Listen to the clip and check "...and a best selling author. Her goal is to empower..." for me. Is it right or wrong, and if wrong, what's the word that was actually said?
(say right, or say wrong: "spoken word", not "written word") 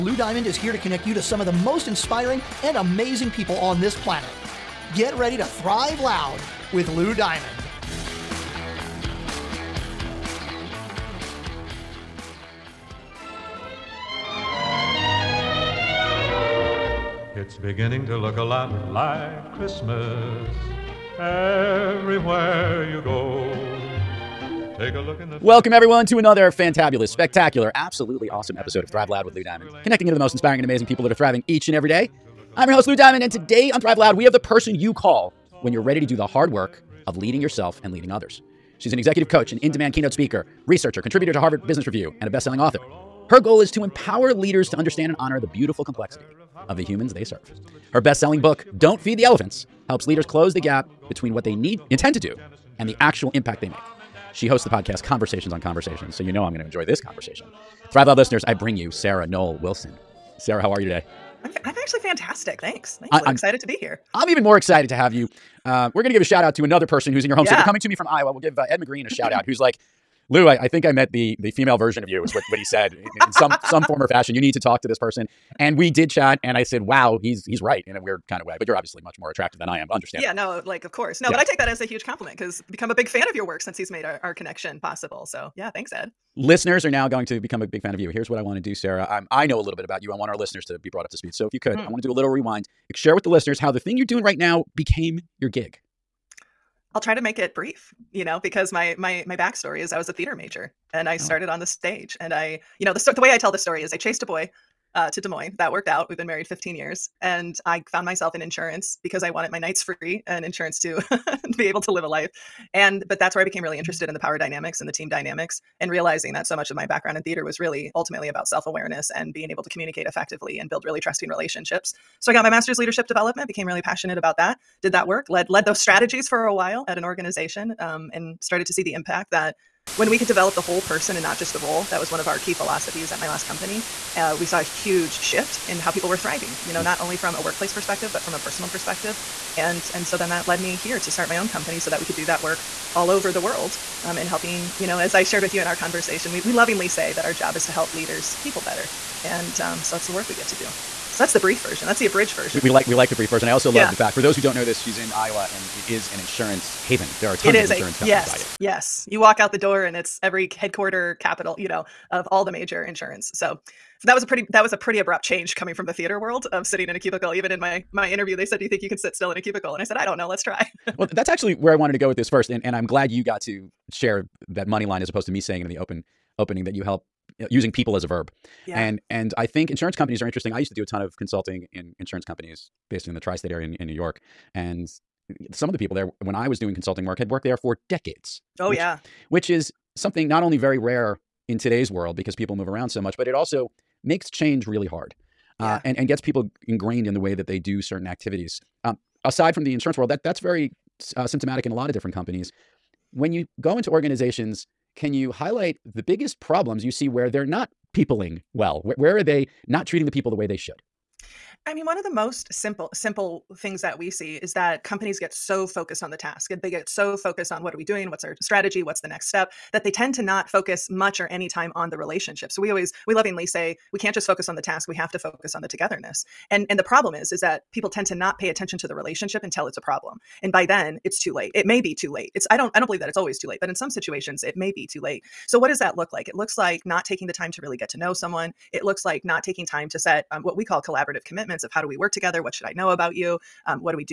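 right.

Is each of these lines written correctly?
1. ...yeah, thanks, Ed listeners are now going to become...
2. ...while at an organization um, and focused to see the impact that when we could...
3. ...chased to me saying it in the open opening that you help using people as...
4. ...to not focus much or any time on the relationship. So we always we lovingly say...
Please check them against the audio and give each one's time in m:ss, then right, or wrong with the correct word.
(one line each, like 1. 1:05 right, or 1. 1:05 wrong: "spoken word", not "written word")
1. 1:25 right
2. 2:06 wrong: "started", not "focused"
3. 2:55 wrong: "opposed", not "chased"
4. 3:40 right.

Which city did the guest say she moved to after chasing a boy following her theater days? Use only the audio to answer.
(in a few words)
Des Moines.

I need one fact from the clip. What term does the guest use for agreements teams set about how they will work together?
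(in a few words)
collaborative commitments.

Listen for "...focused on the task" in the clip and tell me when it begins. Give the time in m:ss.
3:35.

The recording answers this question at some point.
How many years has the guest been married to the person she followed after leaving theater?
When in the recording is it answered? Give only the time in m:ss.
1:46.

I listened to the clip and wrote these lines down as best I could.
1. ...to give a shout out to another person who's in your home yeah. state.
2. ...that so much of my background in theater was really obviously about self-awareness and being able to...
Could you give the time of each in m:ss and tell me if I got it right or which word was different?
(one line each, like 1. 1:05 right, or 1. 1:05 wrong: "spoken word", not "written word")
1. 1:06 right
2. 1:56 wrong: "ultimately", not "obviously".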